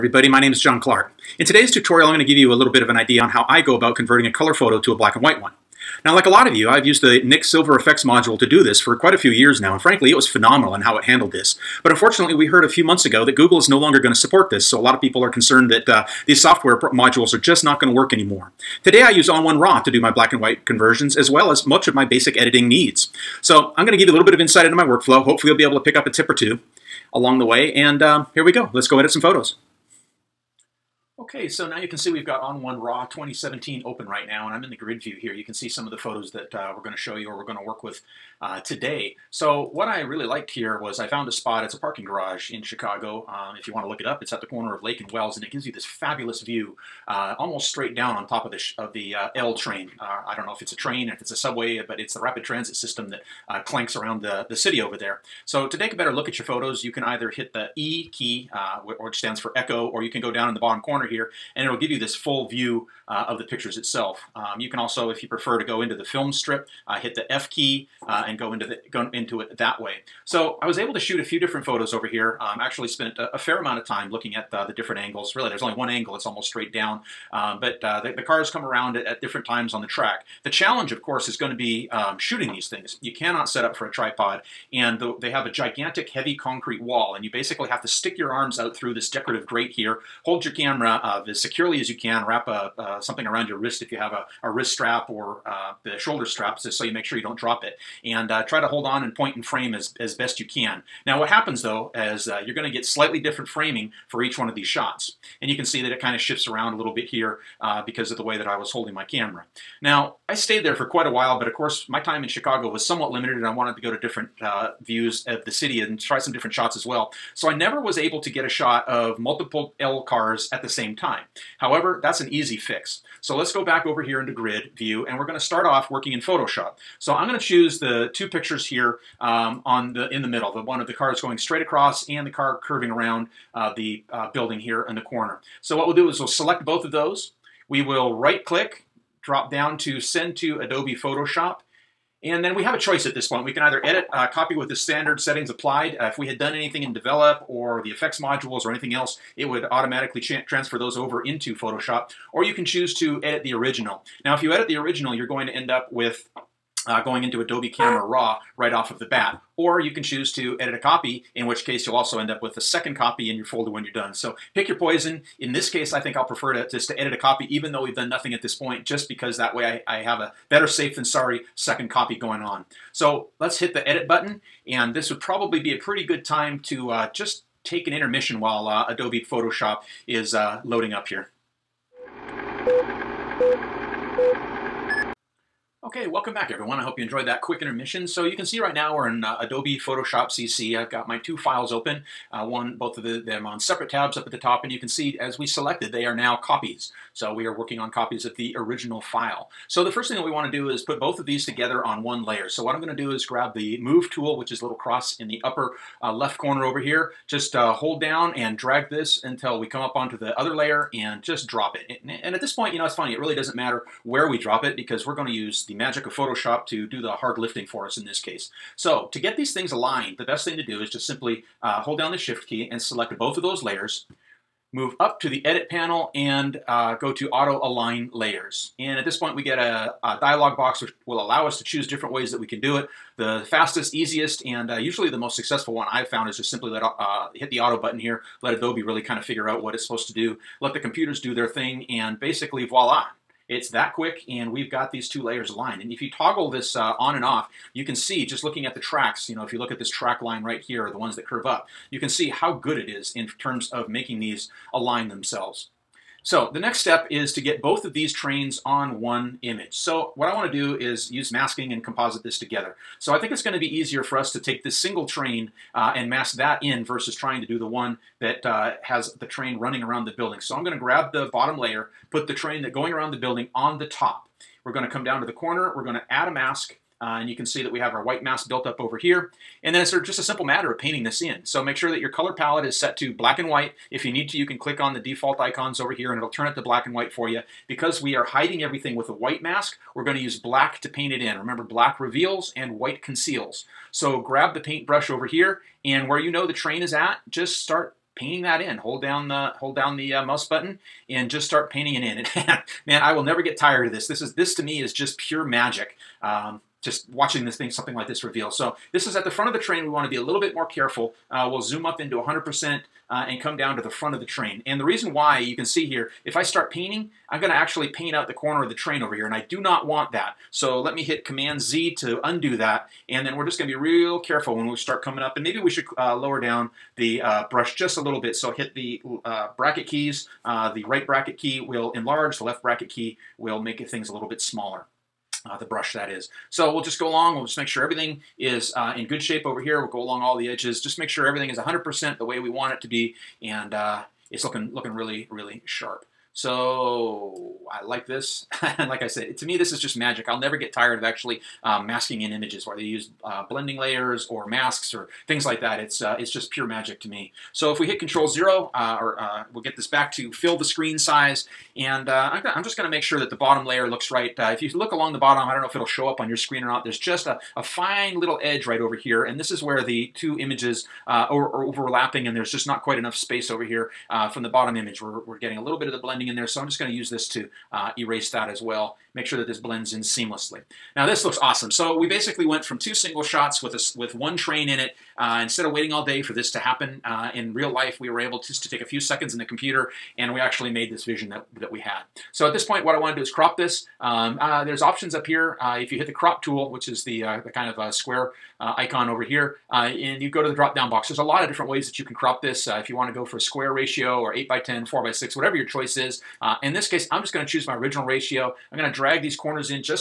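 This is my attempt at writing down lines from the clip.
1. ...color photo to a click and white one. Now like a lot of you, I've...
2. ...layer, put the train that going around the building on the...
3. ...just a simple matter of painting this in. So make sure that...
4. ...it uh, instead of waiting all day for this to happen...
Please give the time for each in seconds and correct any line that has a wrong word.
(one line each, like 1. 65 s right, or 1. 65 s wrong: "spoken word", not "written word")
1. 4 s wrong: "black", not "click"
2. 271 s right
3. 280 s right
4. 384 s right.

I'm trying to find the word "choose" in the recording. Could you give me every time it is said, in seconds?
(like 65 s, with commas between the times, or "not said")
127 s, 152 s, 160 s, 231 s, 407 s.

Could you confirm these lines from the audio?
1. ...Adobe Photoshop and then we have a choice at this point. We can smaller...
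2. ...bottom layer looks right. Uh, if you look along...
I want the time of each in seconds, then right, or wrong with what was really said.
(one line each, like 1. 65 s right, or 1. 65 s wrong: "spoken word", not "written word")
1. 140 s wrong: "either", not "smaller"
2. 363 s right.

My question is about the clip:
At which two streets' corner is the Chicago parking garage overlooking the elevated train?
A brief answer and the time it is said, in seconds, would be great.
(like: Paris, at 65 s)
Lake and Wells, at 44 s.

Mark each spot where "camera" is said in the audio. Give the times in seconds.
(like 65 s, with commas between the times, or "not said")
90 s, 109 s, 157 s.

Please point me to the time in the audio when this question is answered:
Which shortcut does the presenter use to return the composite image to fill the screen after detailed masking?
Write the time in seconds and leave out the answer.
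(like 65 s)
357 s.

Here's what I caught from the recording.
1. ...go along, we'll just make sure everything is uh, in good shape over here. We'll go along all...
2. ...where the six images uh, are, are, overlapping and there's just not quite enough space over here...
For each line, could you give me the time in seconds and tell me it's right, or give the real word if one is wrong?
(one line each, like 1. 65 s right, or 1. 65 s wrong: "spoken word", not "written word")
1. 336 s right
2. 369 s wrong: "two", not "six".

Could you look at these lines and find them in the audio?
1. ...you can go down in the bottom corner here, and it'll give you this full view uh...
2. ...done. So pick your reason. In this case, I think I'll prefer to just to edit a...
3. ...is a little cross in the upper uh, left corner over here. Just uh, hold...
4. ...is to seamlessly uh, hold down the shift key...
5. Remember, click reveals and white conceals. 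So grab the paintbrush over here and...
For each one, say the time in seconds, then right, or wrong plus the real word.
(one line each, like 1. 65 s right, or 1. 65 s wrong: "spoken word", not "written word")
1. 60 s right
2. 163 s wrong: "poison", not "reason"
3. 204 s right
4. 220 s wrong: "simply", not "seamlessly"
5. 291 s wrong: "black", not "click".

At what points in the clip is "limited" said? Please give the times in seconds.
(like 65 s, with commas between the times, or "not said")
113 s.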